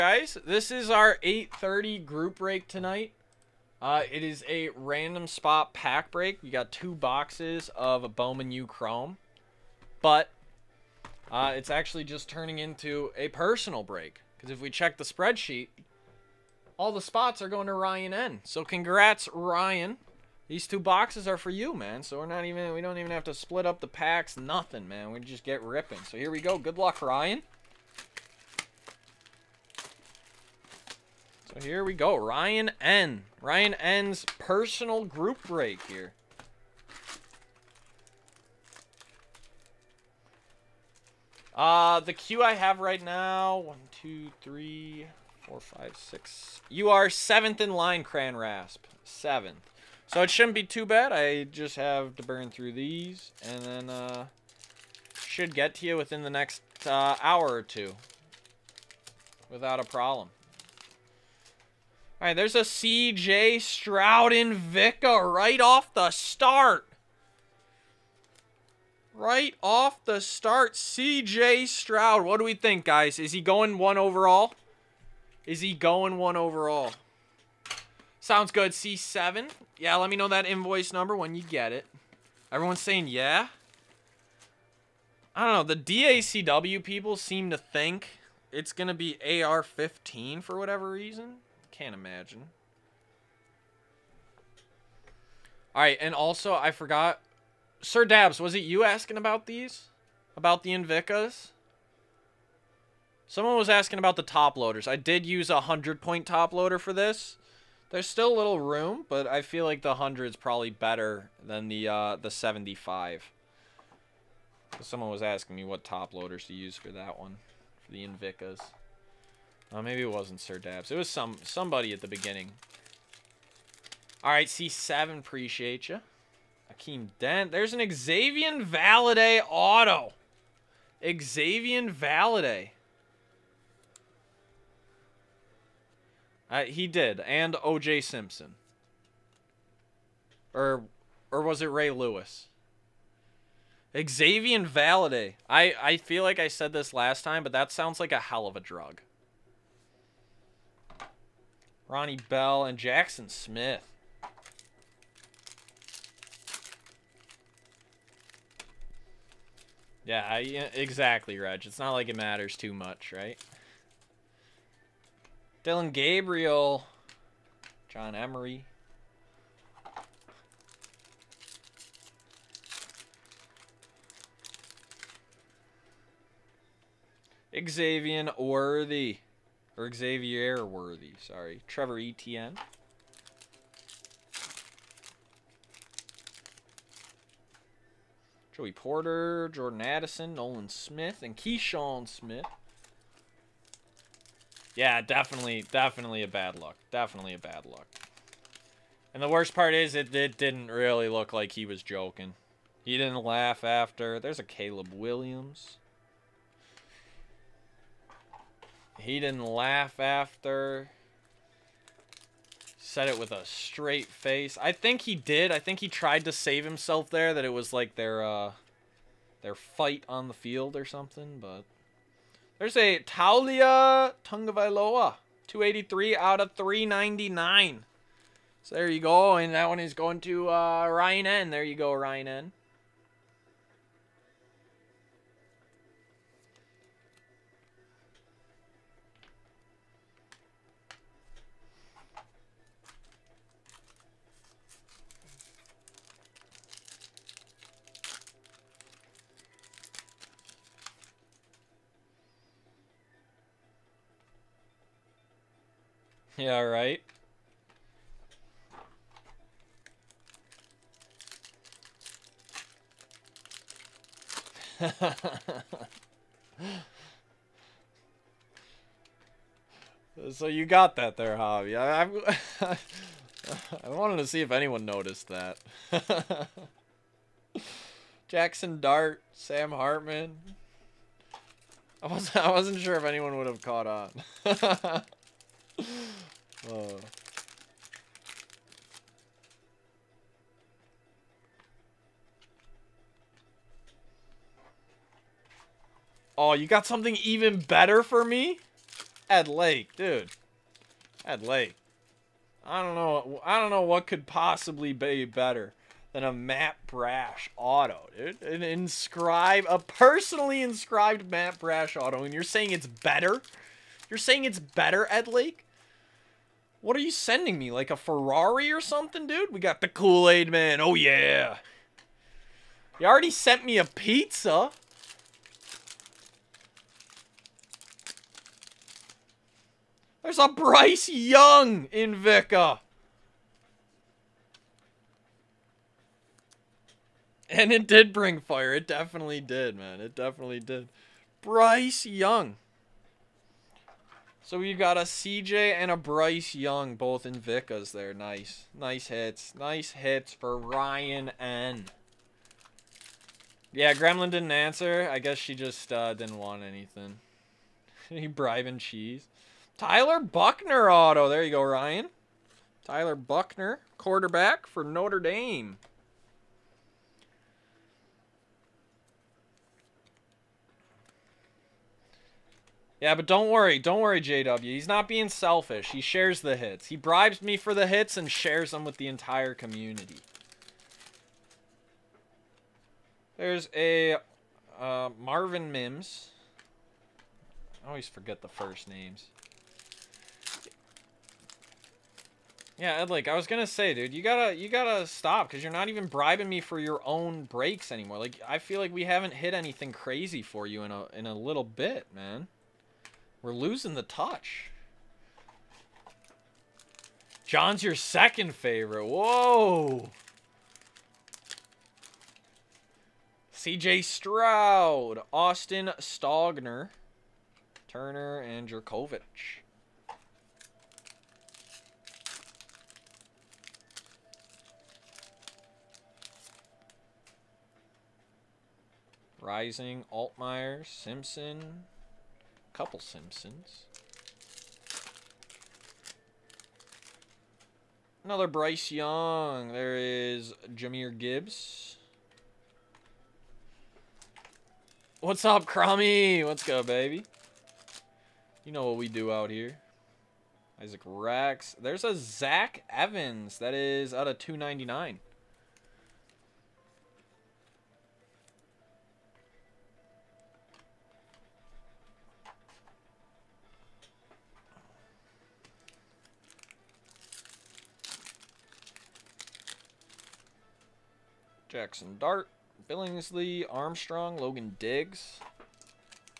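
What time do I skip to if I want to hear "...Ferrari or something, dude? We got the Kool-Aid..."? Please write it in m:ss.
5:17.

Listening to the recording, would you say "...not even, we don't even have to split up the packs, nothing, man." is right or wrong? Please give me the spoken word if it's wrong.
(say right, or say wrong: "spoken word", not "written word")
right.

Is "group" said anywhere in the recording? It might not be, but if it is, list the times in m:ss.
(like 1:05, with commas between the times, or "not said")
0:02, 0:35.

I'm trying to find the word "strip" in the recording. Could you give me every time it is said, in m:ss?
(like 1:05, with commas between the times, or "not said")
not said.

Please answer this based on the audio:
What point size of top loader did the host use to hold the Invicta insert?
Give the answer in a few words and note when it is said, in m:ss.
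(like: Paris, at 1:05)
100, at 1:45.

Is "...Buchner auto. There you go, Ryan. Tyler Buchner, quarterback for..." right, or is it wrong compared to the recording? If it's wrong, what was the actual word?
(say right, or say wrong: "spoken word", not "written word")
right.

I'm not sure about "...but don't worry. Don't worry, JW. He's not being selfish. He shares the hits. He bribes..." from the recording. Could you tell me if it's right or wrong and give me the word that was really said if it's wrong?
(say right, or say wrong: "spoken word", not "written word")
right.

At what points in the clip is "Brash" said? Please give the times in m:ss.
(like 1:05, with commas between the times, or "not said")
5:06, 5:11.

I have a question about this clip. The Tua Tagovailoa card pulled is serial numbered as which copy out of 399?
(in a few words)
283.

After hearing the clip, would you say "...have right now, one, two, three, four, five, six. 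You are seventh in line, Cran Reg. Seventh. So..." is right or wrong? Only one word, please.
wrong.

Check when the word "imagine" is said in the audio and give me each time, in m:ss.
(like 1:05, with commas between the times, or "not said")
1:31.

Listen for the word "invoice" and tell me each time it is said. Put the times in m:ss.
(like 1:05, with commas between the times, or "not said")
1:20.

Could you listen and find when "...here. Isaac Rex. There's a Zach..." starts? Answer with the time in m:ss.
7:29.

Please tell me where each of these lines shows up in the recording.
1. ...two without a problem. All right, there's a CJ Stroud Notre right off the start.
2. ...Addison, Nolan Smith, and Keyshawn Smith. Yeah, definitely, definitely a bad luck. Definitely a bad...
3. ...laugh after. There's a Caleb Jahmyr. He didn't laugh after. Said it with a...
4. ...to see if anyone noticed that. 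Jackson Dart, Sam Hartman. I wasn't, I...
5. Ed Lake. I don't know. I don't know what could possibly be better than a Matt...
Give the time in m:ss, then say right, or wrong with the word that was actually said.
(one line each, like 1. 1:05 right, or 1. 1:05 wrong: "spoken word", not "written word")
1. 0:57 wrong: "Invicta", not "Notre"
2. 3:09 right
3. 3:23 wrong: "Williams", not "Jahmyr"
4. 4:34 right
5. 5:01 right.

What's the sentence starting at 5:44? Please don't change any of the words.
So we got a CJ and a Bryce Young, both Invictas there.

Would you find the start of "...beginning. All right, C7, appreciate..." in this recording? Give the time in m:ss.
2:02.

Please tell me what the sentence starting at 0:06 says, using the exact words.
We got two boxes of a Bowman U Chrome.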